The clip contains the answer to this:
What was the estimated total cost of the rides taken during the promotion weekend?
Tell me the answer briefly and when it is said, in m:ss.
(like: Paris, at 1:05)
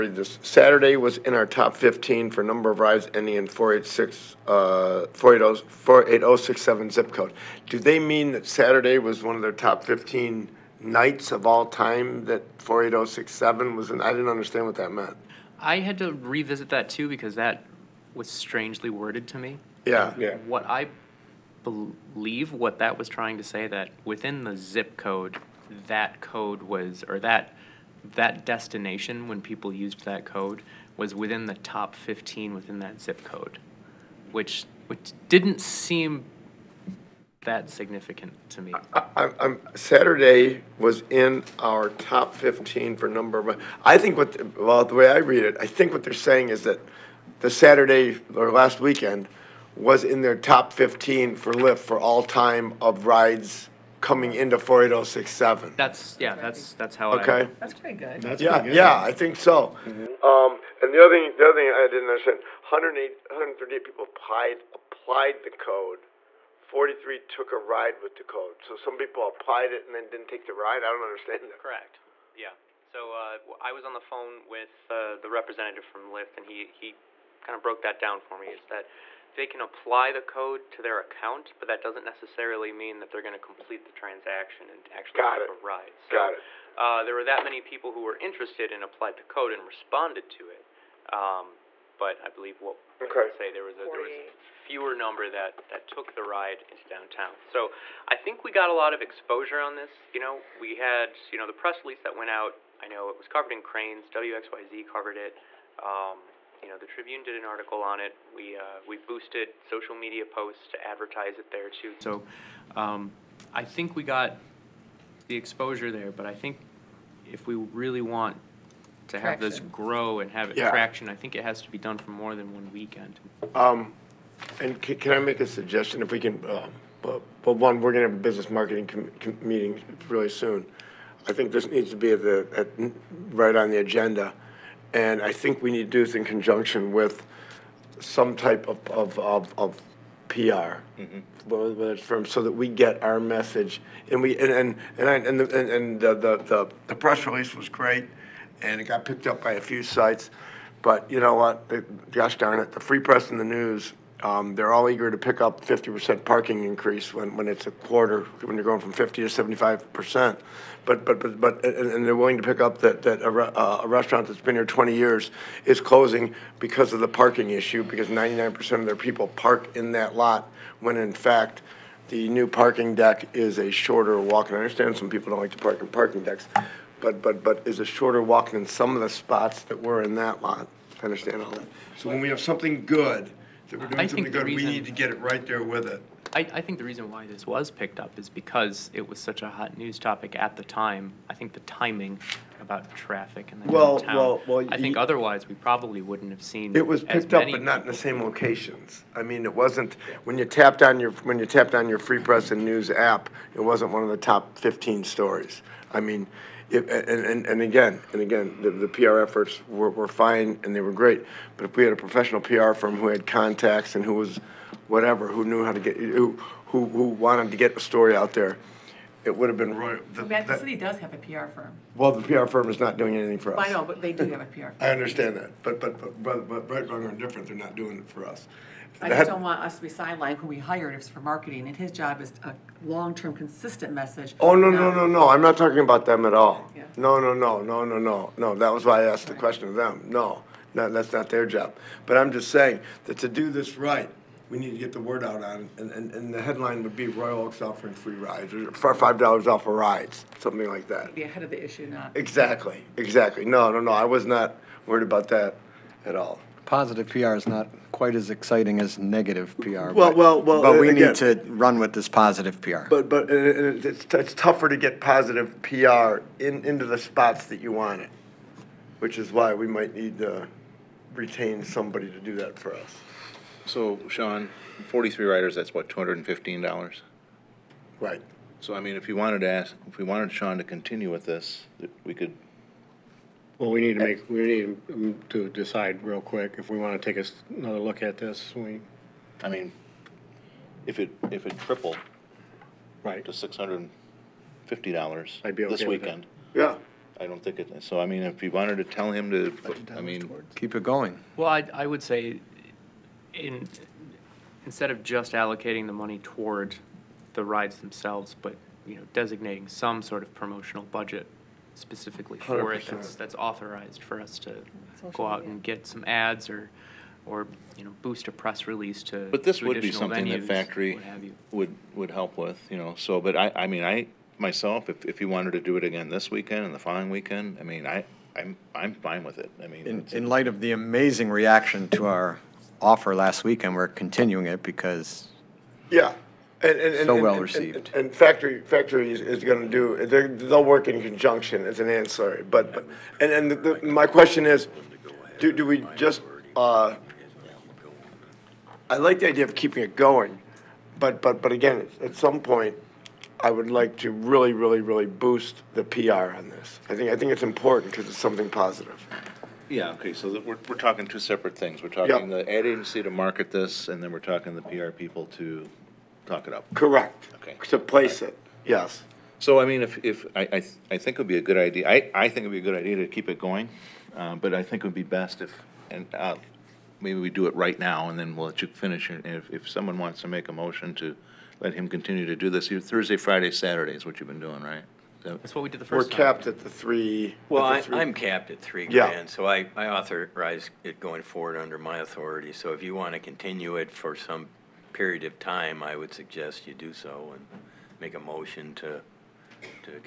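$215, at 4:35.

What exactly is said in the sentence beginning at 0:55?
That's, yeah, that's, that's how I.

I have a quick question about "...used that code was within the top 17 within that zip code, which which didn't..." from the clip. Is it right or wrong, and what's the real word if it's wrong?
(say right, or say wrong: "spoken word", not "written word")
wrong: "15", not "17".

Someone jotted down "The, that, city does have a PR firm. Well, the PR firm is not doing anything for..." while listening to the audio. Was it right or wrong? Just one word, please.
right.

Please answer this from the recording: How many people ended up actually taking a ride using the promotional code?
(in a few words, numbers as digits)
43.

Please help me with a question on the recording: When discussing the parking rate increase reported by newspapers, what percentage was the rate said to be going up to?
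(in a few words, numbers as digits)
75%.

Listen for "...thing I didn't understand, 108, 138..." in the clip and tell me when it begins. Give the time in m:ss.
1:01.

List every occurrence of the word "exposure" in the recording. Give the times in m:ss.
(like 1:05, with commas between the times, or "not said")
1:39, 1:55.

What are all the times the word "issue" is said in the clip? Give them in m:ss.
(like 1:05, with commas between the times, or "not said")
2:47, 4:11.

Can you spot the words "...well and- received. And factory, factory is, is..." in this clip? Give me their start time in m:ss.
5:37.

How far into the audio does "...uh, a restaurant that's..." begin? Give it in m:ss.
2:43.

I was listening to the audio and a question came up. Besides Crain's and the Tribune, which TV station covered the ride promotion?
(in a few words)
WXYZ.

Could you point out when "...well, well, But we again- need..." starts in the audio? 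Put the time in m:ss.
4:20.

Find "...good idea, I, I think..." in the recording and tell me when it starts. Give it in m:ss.
6:11.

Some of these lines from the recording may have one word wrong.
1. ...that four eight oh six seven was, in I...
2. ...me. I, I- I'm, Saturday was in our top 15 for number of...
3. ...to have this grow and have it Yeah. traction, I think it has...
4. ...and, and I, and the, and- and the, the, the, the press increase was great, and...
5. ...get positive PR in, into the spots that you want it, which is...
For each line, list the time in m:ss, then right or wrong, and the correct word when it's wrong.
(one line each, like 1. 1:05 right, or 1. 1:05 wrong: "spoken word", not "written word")
1. 0:12 right
2. 0:38 right
3. 1:59 right
4. 2:24 wrong: "release", not "increase"
5. 4:24 right.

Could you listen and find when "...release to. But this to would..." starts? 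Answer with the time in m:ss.
5:18.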